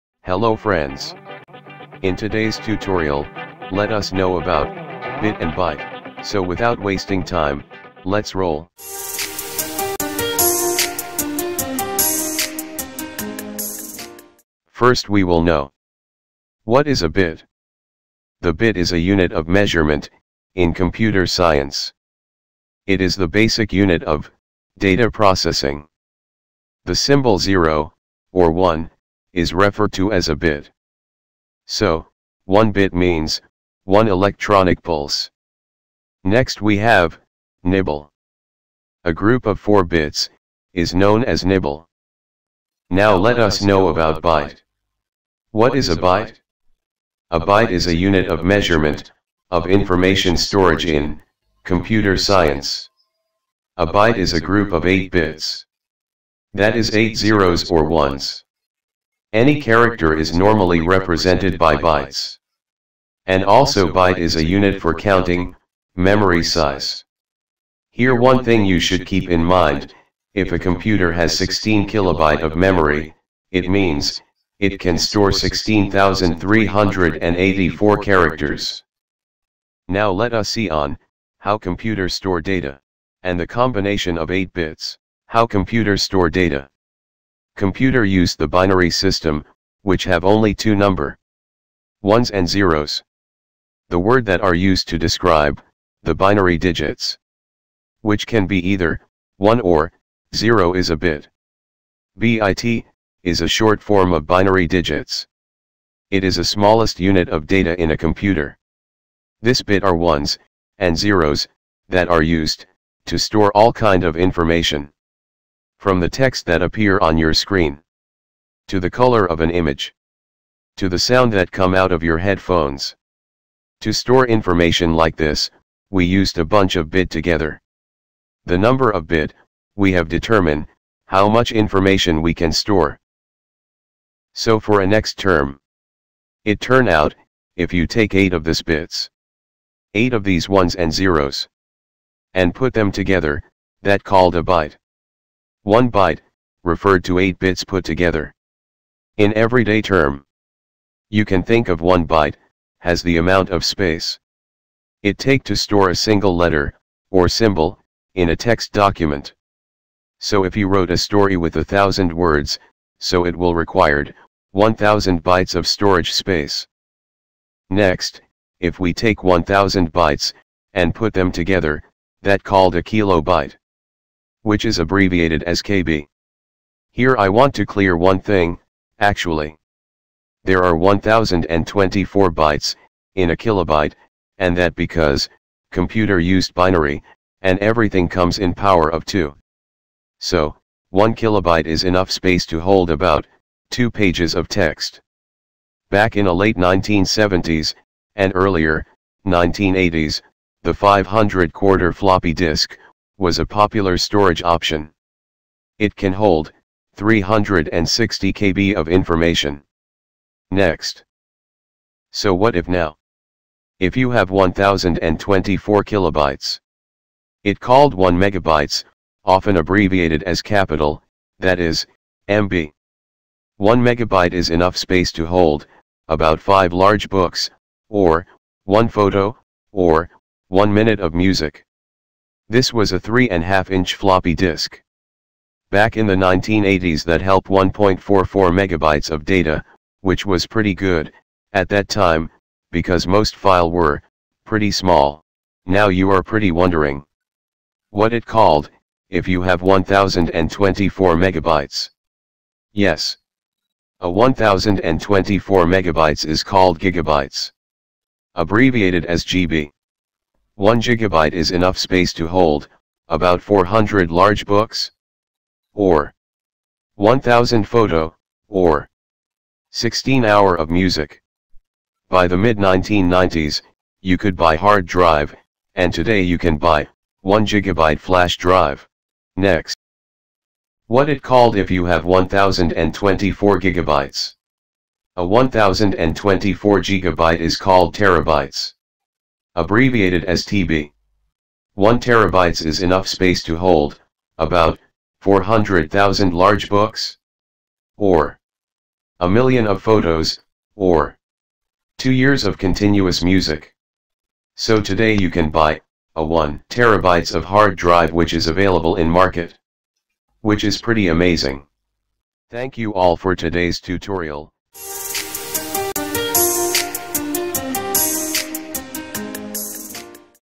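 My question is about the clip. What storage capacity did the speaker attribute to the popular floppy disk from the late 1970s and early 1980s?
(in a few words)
360 KB.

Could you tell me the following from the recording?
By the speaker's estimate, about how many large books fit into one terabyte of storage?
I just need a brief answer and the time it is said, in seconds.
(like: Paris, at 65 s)
400,000, at 295 s.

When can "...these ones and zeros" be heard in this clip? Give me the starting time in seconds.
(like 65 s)
140 s.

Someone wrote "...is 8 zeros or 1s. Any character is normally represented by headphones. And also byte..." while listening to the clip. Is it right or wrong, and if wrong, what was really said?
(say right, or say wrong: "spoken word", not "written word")
wrong: "bytes", not "headphones".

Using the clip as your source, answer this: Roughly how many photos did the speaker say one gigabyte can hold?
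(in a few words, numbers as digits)
1000.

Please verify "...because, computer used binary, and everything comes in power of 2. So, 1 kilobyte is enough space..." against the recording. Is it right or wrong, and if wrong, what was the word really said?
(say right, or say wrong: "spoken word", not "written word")
right.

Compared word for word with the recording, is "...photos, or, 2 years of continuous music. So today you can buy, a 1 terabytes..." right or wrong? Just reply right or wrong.
right.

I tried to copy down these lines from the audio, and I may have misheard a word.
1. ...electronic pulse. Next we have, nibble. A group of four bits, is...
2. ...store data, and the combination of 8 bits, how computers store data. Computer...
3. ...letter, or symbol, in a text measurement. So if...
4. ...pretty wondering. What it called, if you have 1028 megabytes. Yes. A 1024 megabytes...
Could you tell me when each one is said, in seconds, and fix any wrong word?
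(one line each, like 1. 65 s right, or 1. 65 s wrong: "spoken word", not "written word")
1. 34 s right
2. 82 s right
3. 156 s wrong: "document", not "measurement"
4. 246 s wrong: "1024", not "1028".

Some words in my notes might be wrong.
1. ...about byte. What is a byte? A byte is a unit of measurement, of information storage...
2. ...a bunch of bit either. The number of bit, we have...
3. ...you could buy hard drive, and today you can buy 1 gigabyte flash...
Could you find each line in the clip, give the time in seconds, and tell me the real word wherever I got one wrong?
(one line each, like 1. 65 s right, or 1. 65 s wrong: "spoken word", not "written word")
1. 43 s right
2. 126 s wrong: "together", not "either"
3. 274 s right.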